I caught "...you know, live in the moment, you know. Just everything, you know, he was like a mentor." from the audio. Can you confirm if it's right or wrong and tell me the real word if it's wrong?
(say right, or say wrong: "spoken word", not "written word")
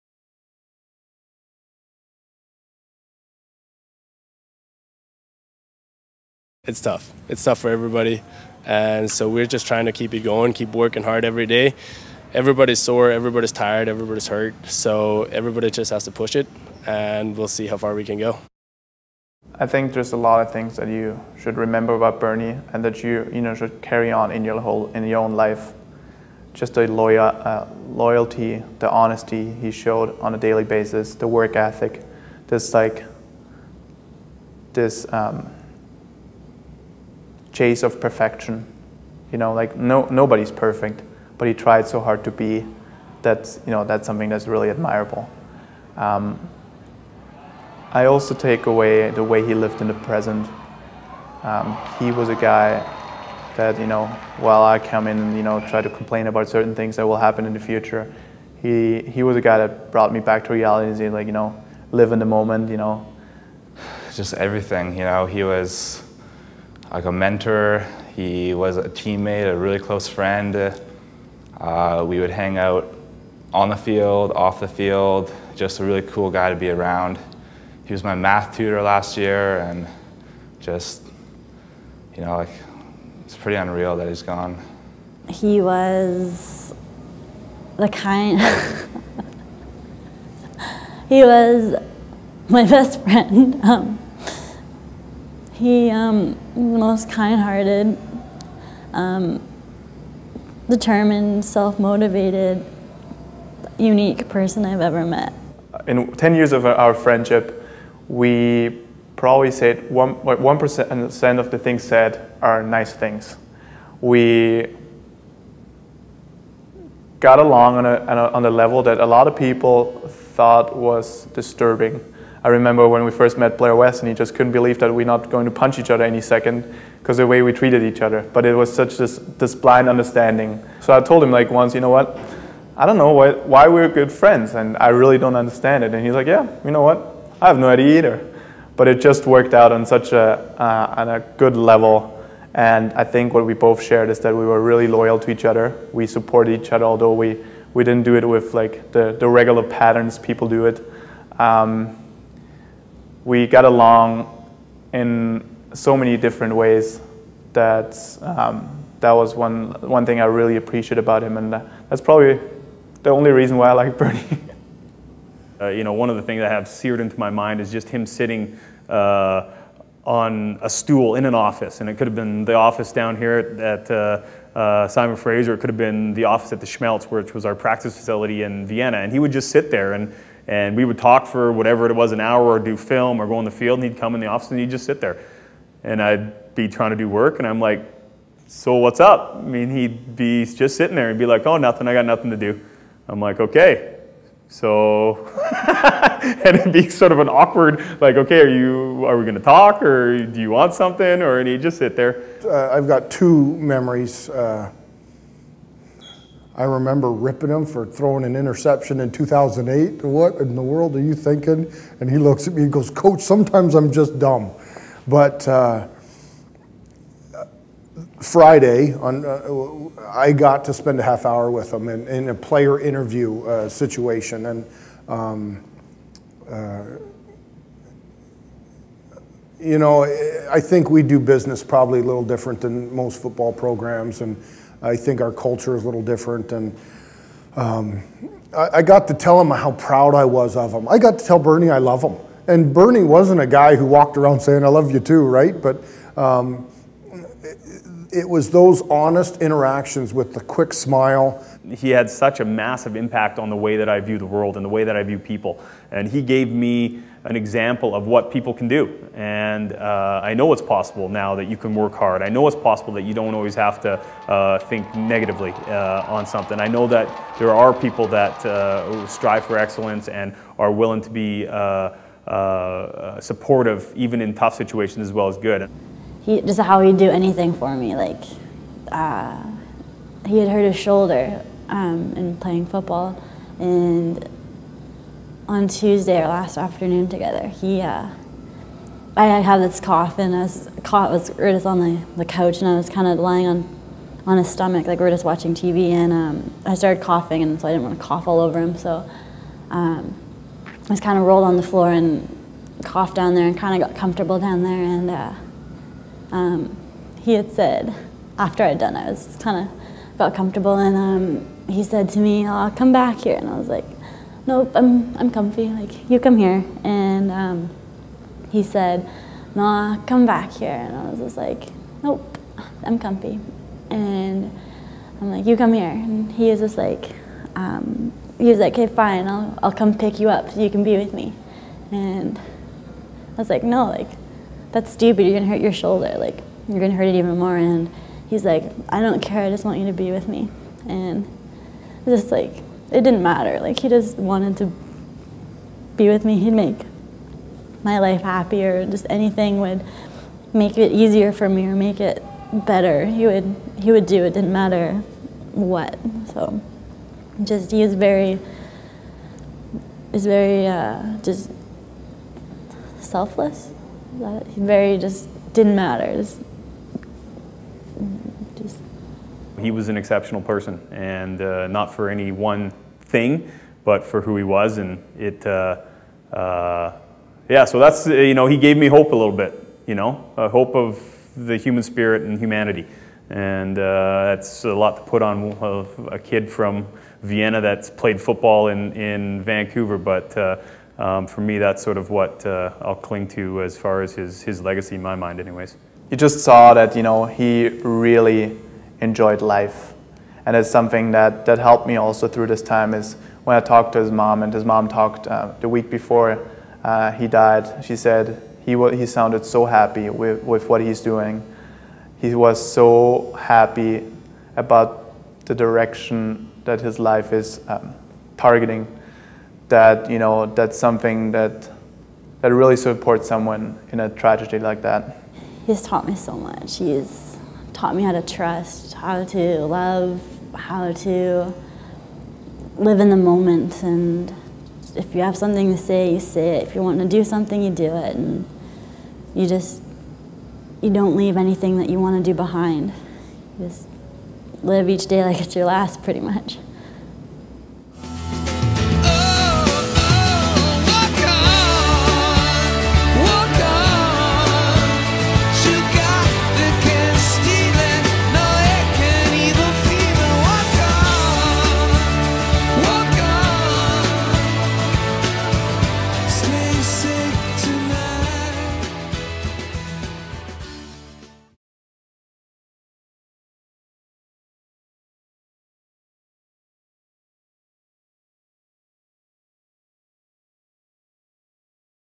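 right.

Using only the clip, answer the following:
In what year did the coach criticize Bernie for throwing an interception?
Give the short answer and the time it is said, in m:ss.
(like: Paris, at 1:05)
2008, at 3:29.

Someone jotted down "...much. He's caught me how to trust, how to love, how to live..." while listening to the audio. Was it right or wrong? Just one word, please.
wrong.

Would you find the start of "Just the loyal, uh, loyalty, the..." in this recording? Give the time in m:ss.
0:26.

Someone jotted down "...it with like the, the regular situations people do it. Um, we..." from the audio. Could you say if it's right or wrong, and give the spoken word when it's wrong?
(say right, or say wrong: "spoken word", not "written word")
wrong: "patterns", not "situations".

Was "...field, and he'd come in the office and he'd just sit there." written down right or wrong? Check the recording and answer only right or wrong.
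right.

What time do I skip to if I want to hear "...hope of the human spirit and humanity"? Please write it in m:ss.
6:20.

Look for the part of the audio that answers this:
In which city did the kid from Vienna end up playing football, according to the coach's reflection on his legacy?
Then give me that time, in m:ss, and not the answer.
6:29.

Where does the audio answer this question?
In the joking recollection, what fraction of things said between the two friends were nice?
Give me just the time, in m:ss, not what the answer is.
1:49.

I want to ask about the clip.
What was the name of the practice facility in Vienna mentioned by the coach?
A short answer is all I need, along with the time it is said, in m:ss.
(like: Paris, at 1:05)
Schmelz, at 2:56.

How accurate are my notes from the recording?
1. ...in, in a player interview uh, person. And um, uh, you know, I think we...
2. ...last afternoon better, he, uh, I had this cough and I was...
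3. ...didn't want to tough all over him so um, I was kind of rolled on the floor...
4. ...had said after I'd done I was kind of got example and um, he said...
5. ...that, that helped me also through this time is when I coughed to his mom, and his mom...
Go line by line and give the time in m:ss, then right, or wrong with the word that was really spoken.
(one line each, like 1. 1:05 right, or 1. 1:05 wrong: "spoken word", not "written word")
1. 3:41 wrong: "situation", not "person"
2. 4:46 wrong: "together", not "better"
3. 4:57 wrong: "cough", not "tough"
4. 5:07 wrong: "comfortable", not "example"
5. 6:41 wrong: "talked", not "coughed".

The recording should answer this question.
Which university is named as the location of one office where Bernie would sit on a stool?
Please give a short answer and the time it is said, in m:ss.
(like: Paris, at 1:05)
Simon Fraser, at 2:54.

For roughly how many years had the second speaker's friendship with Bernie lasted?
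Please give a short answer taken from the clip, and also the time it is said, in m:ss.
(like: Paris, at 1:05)
10, at 1:46.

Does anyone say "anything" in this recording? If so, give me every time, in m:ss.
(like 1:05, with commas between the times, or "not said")
4:37, 5:49, 7:21.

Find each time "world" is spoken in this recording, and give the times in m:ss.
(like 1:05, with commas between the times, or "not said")
3:30, 4:14.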